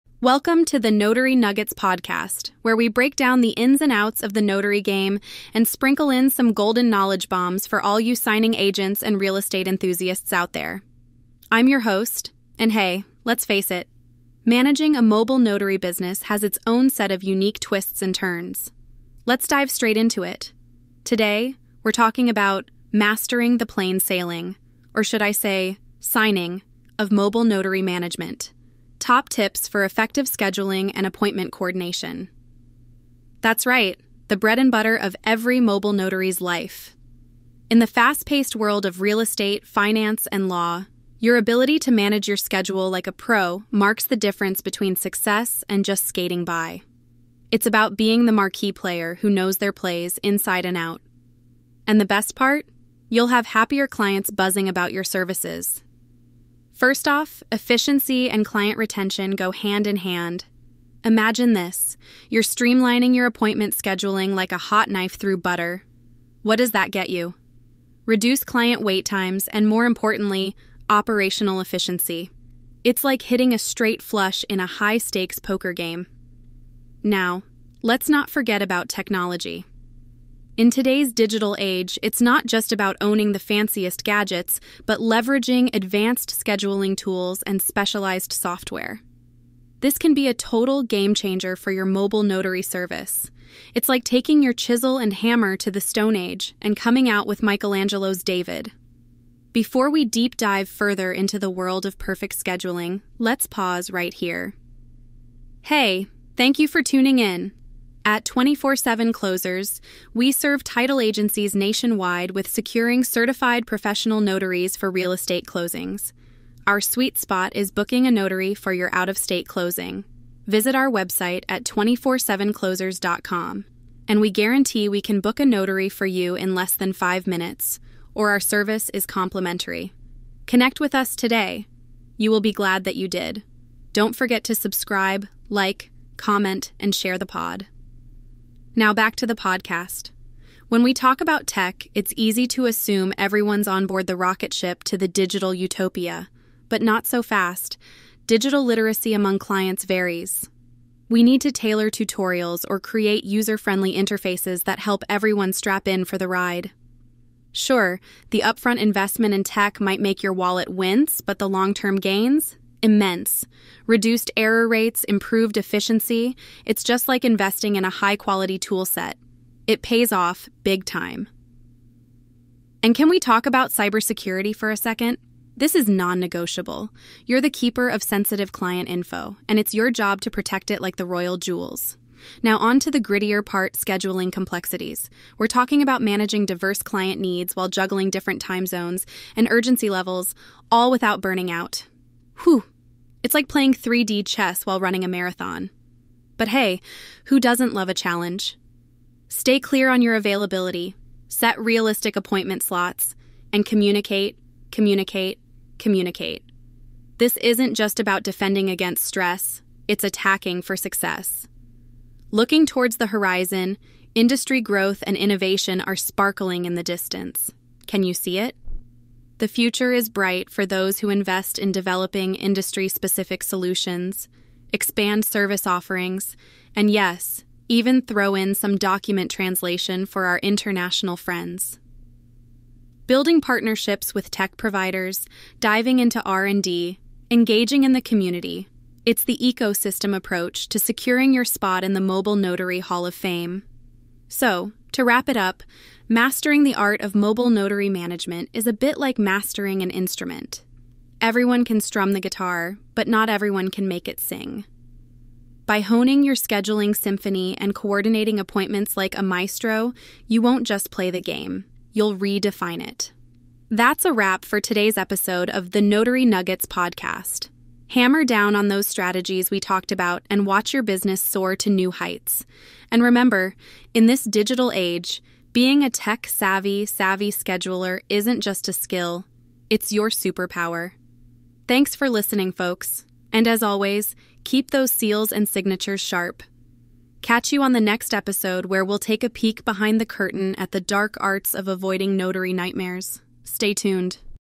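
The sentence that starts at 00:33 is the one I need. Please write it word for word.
That's right, the bread and butter of every mobile notary's life.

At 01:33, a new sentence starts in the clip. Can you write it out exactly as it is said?
It's like taking your chisel and hammer to the Stone Age and coming out with Michelangelo's David.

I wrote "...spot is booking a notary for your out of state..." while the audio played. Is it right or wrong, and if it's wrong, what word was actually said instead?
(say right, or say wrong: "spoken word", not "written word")
right.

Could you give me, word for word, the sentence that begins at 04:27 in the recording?
Hammer down on those strategies we talked about and watch your business soar to new heights.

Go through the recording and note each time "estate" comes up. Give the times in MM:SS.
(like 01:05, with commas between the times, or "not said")
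00:09, 00:39, 01:55.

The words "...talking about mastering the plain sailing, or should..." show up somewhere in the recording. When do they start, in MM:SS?
00:21.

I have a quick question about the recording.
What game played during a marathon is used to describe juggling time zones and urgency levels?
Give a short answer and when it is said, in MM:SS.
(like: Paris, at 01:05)
3D chess, at 03:13.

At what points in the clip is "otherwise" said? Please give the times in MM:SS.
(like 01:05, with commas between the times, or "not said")
not said.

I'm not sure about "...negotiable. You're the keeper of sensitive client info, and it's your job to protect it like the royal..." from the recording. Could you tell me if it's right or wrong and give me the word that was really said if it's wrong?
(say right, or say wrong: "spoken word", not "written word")
right.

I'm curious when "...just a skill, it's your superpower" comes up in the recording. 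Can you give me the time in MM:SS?
04:38.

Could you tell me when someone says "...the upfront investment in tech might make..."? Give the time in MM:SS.
02:38.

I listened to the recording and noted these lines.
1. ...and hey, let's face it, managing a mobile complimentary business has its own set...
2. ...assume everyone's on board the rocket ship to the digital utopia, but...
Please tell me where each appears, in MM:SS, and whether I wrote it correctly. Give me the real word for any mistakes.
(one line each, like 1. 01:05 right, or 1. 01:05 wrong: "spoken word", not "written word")
1. 00:12 wrong: "notary", not "complimentary"
2. 02:22 right.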